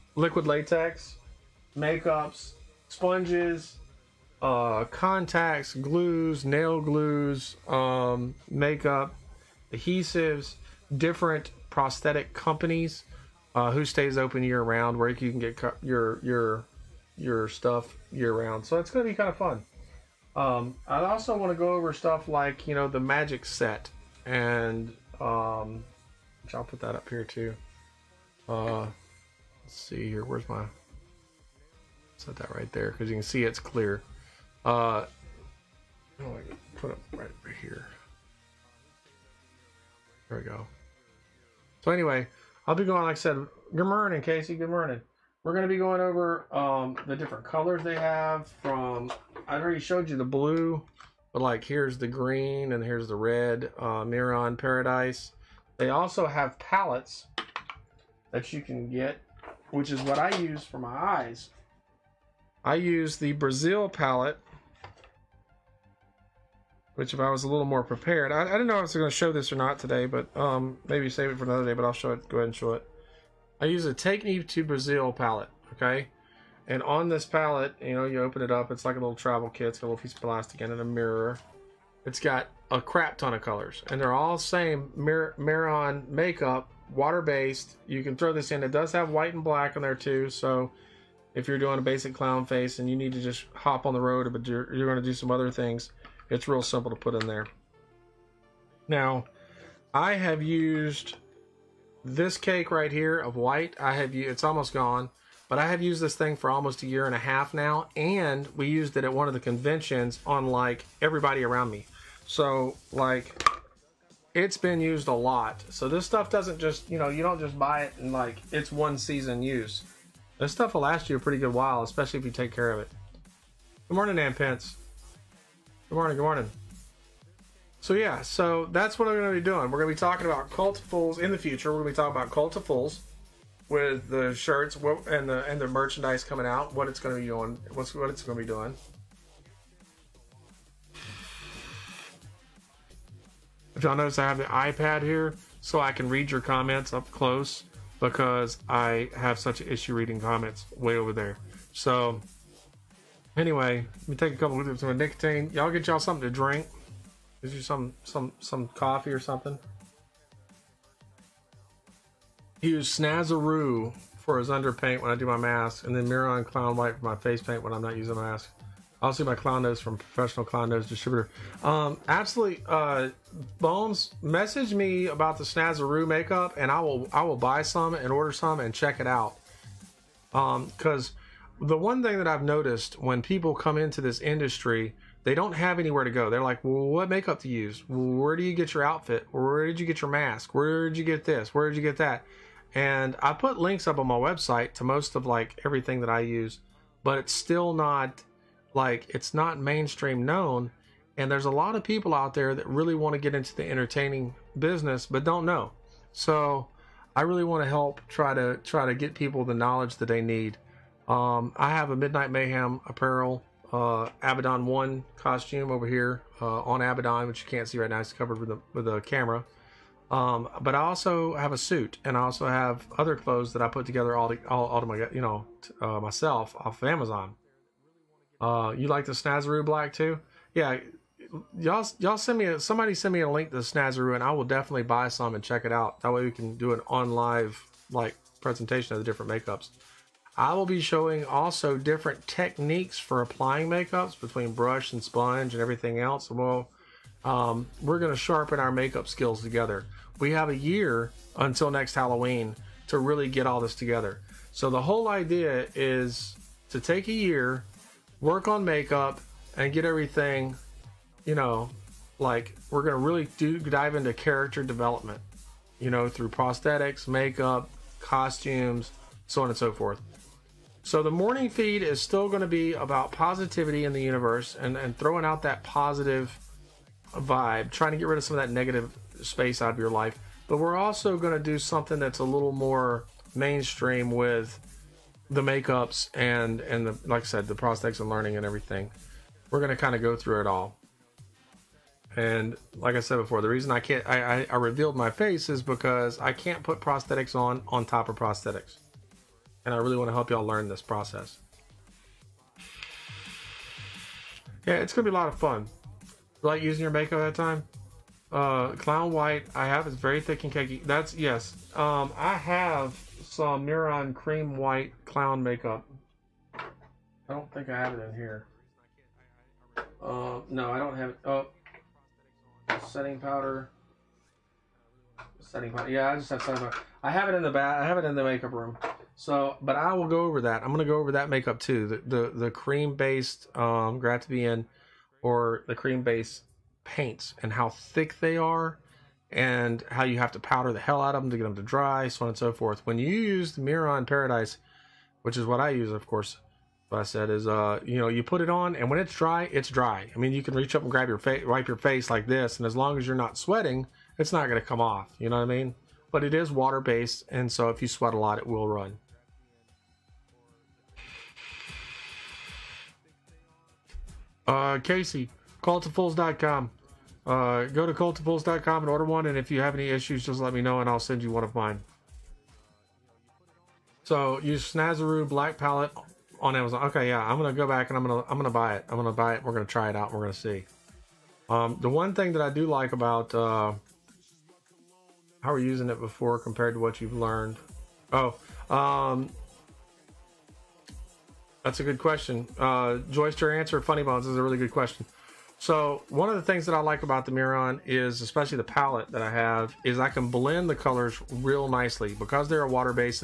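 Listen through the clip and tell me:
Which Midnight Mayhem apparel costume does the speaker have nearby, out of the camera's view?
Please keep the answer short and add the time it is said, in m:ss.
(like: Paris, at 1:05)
Abaddon 1, at 3:34.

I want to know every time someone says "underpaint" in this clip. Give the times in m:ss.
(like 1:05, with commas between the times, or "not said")
2:44.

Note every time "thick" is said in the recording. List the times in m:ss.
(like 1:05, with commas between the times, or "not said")
5:10, 5:37.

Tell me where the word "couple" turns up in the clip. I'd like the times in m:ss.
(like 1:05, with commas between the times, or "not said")
2:34.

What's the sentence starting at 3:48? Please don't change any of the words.
Uh, you like the Snazaroo black too?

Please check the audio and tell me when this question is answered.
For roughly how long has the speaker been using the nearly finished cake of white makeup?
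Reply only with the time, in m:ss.
1:46.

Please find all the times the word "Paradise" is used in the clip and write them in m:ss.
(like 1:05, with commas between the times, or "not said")
0:54, 5:44.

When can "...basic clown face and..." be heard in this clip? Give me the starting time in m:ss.
1:31.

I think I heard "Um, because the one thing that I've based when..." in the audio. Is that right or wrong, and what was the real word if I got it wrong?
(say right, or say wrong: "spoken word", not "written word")
wrong: "noticed", not "based".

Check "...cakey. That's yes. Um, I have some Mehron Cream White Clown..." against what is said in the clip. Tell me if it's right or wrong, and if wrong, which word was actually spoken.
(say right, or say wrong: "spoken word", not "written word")
right.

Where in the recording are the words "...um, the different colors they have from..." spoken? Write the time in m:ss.
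0:46.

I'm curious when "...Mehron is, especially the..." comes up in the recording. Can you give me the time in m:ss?
6:37.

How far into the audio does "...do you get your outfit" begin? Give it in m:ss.
3:08.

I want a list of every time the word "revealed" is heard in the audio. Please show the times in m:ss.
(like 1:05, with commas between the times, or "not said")
4:54.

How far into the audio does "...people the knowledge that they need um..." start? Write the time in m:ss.
3:29.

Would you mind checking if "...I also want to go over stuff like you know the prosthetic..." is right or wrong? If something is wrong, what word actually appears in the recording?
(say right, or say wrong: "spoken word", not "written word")
wrong: "magic", not "prosthetic".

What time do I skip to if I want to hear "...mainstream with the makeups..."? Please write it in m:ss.
4:43.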